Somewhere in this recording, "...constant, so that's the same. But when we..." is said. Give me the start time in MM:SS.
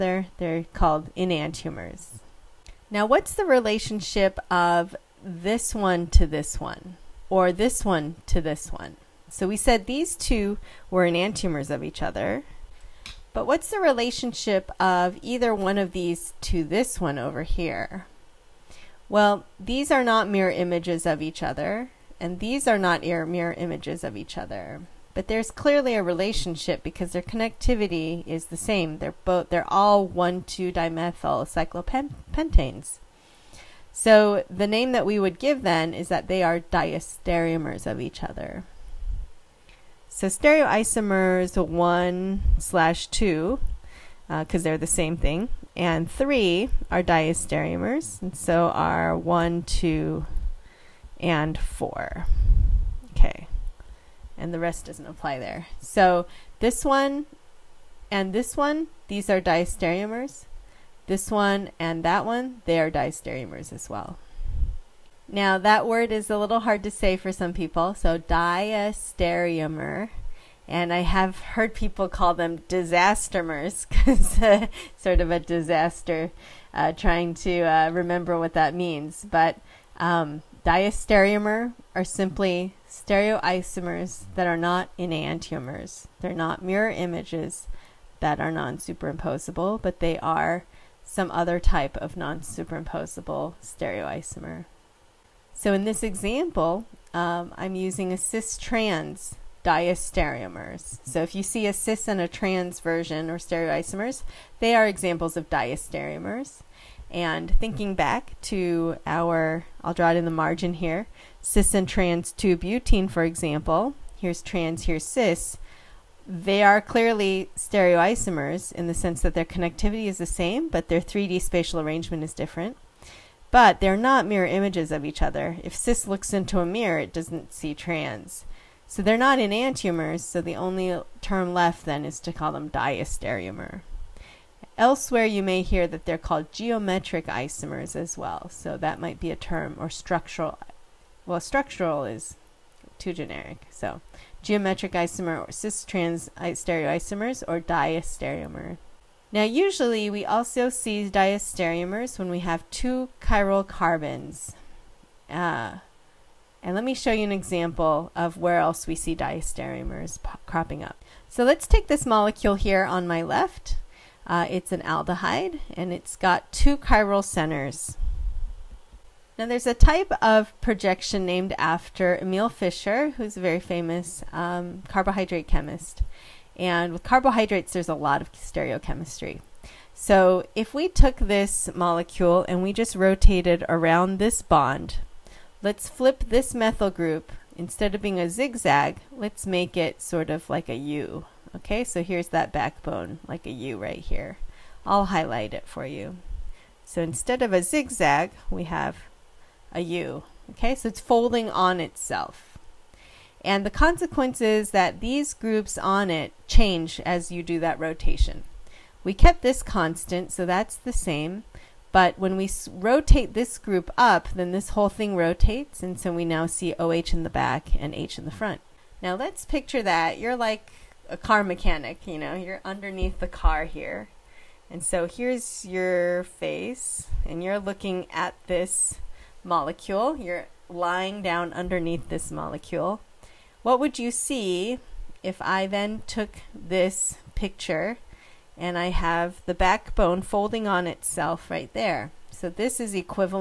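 03:29.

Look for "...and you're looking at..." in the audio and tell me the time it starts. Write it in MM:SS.
03:47.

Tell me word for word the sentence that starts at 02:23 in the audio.
So geometric isomer or cis-trans stereoisomers or diastereomer.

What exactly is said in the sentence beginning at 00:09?
So we said these two were enantiomers of each other.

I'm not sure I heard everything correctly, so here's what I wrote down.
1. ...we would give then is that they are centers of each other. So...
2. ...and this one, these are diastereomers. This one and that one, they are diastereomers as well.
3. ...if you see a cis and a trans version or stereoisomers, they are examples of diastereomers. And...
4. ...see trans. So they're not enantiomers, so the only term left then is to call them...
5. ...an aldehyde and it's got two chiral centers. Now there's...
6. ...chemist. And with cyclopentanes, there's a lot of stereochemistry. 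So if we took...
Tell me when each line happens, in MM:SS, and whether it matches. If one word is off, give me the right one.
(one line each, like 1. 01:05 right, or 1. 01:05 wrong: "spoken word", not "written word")
1. 00:35 wrong: "diastereomers", not "centers"
2. 00:58 right
3. 01:41 right
4. 02:07 right
5. 02:44 right
6. 02:55 wrong: "carbohydrates", not "cyclopentanes".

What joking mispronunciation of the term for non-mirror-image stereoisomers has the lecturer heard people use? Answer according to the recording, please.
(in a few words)
disastermers.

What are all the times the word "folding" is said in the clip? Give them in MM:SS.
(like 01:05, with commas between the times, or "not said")
03:20, 04:00.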